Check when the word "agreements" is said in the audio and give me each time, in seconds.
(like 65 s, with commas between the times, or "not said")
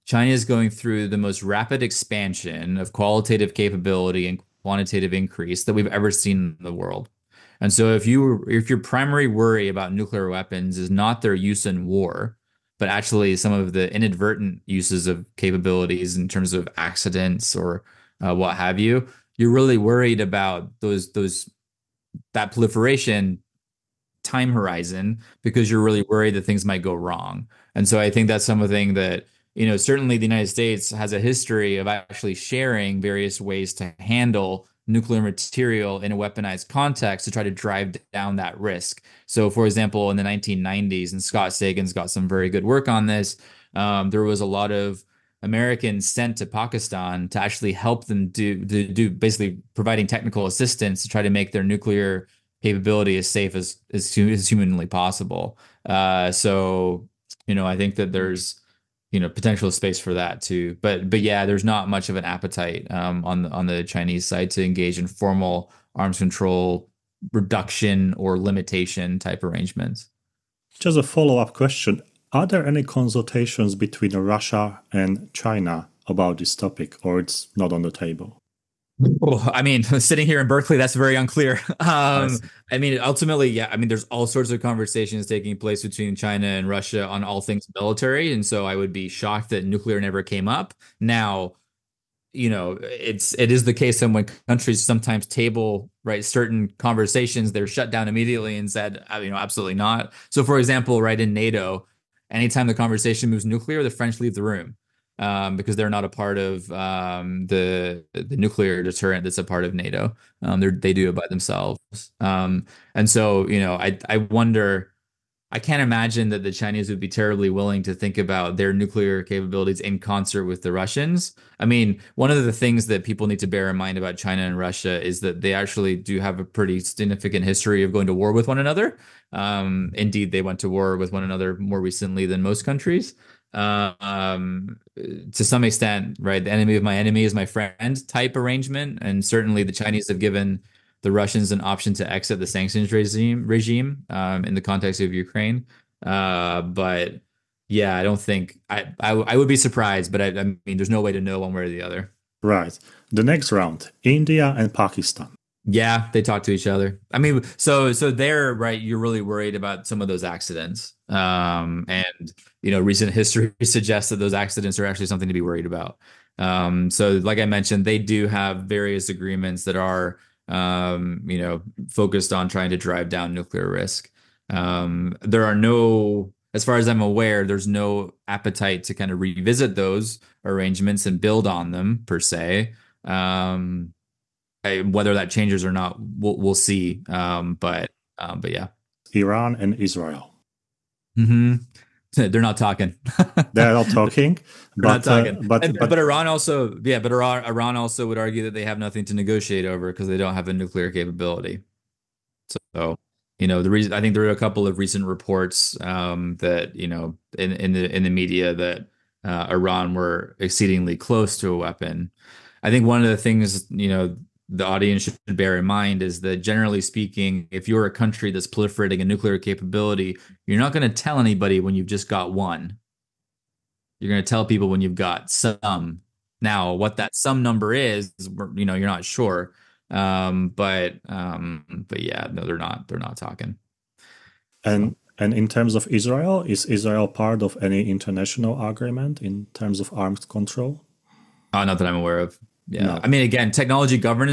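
169 s, 238 s.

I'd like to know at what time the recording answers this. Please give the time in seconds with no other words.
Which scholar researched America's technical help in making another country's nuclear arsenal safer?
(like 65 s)
41 s.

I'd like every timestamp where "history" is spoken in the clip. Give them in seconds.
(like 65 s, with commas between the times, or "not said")
31 s, 127 s, 163 s.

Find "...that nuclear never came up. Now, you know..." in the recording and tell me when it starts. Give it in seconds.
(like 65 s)
89 s.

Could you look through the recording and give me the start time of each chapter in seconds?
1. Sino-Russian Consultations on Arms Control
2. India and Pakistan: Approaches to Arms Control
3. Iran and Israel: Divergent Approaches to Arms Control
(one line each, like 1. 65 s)
1. 77 s
2. 154 s
3. 189 s.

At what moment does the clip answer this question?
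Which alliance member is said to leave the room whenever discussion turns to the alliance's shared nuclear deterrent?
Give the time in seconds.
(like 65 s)
103 s.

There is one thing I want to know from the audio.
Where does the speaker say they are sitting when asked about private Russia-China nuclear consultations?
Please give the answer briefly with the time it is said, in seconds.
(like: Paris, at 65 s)
Berkeley, at 80 s.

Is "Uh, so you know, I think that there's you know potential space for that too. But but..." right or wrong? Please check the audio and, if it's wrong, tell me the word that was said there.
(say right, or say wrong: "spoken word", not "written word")
right.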